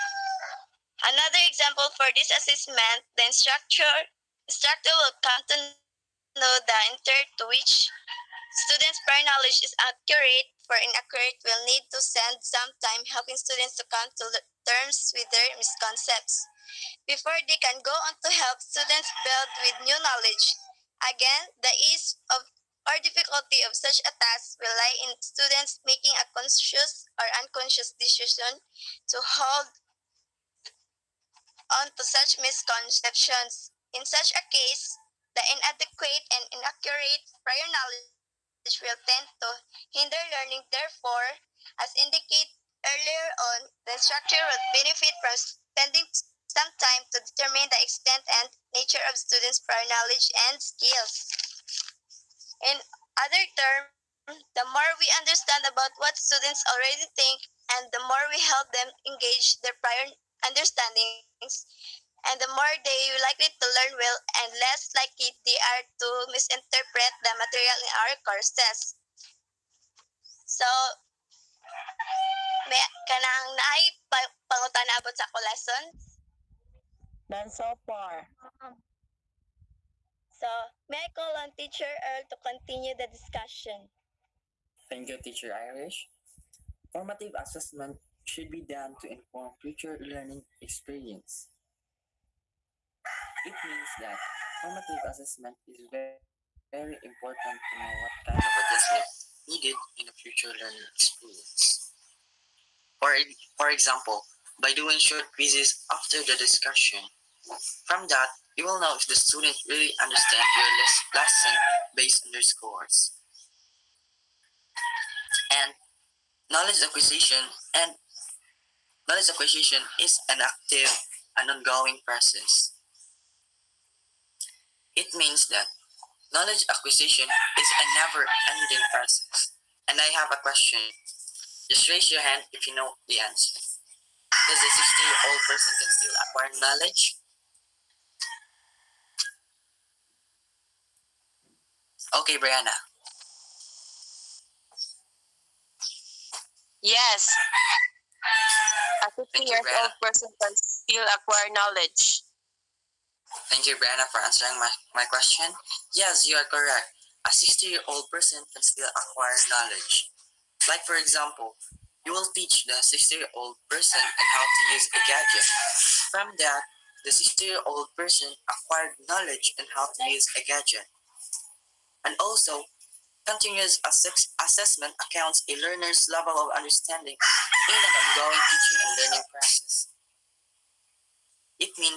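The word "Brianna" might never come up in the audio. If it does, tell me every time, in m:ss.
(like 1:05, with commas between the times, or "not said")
2:22, 2:33.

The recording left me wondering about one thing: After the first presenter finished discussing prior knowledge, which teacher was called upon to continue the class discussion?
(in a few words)
Earl.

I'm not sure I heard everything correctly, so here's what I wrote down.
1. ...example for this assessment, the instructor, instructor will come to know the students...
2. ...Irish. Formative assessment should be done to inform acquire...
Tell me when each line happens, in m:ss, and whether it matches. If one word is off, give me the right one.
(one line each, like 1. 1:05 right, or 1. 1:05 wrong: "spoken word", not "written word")
1. 0:01 wrong: "intent", not "students"
2. 1:25 wrong: "future", not "acquire".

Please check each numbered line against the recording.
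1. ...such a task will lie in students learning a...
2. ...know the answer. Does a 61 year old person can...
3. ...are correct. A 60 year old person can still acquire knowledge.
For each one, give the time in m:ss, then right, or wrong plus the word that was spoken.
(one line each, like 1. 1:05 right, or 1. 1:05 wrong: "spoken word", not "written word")
1. 0:23 wrong: "making", not "learning"
2. 2:12 wrong: "60", not "61"
3. 2:36 right.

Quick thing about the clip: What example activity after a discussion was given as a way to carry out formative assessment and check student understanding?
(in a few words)
Short quizzes.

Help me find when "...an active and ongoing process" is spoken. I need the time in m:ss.
2:00.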